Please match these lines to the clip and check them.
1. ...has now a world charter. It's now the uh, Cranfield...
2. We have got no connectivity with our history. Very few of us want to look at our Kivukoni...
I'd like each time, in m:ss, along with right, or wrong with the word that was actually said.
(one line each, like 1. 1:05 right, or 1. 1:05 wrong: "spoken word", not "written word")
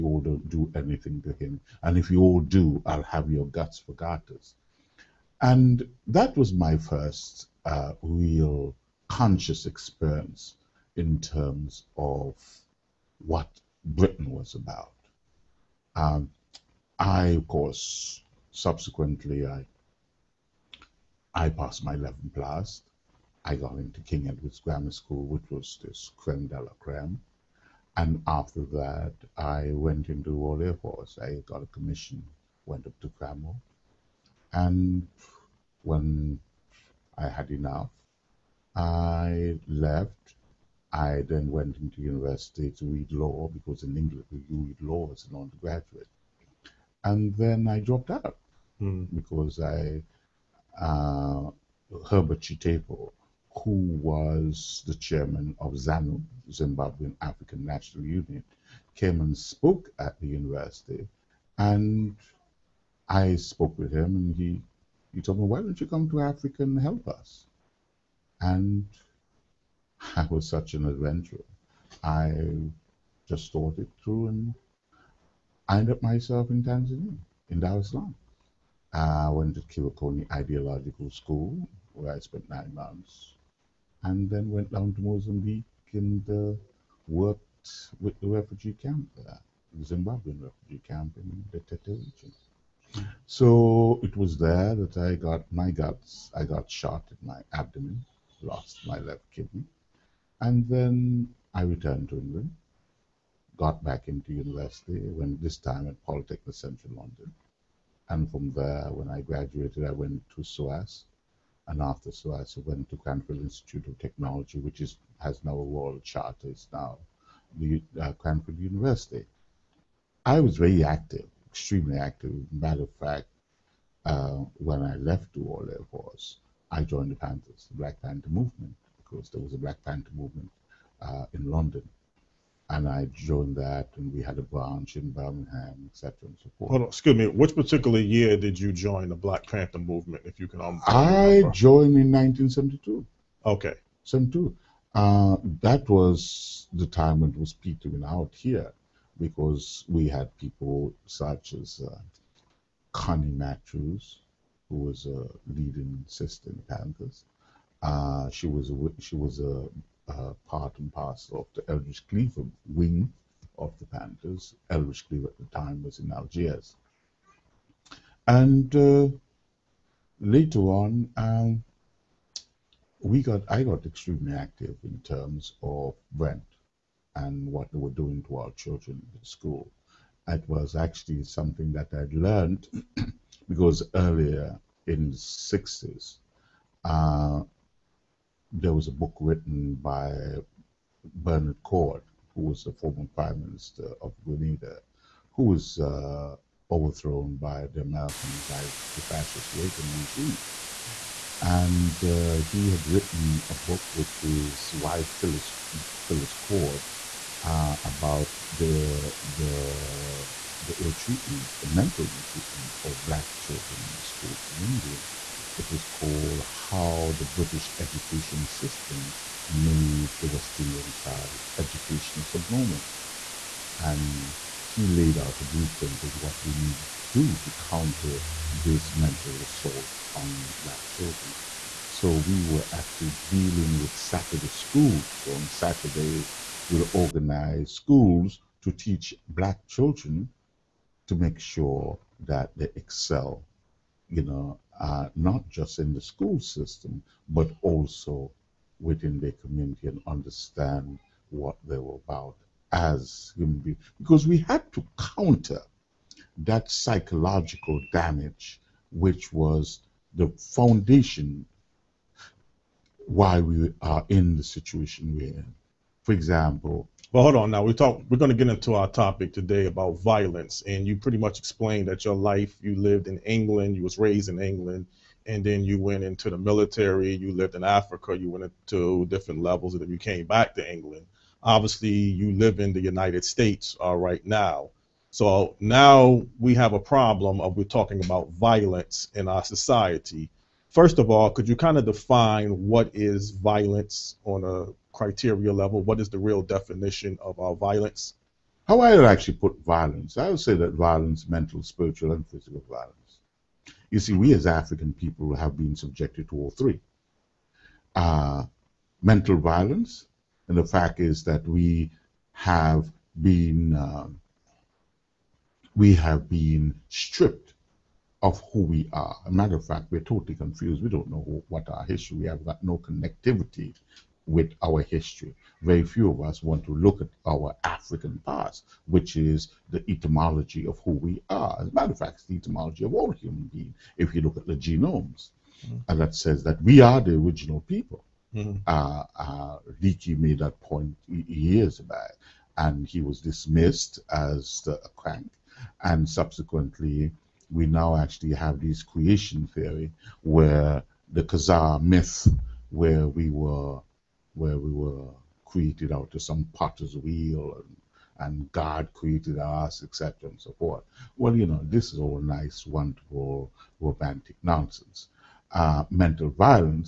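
1. 1:55 right
2. 5:22 wrong: "African", not "Kivukoni".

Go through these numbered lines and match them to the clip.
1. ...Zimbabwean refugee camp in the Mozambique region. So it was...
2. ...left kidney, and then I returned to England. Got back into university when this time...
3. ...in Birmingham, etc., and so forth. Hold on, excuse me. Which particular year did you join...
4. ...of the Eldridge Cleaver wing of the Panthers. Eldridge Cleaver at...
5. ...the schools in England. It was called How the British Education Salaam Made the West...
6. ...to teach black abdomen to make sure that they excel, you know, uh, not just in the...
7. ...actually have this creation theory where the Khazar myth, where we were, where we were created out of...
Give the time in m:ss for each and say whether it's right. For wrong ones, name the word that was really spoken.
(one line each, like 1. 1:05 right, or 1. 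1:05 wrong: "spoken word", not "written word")
1. 1:29 wrong: "Tete", not "Mozambique"
2. 1:38 right
3. 2:14 right
4. 2:41 right
5. 3:33 wrong: "System", not "Salaam"
6. 3:58 wrong: "children", not "abdomen"
7. 5:47 right.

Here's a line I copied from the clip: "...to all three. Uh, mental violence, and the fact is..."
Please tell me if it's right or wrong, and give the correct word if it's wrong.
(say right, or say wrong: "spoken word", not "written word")
right.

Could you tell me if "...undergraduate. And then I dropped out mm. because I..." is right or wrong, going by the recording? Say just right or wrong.
right.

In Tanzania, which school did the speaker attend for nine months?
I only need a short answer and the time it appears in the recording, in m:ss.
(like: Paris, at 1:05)
Kivukoni Ideological School, at 1:19.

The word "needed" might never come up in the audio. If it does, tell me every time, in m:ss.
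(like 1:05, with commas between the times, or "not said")
3:46.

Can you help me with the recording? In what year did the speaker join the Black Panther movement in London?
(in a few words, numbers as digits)
1972.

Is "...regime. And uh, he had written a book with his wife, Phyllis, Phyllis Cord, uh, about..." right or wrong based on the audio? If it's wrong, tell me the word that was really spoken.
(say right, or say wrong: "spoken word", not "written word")
right.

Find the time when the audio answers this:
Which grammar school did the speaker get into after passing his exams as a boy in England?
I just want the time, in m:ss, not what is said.
0:24.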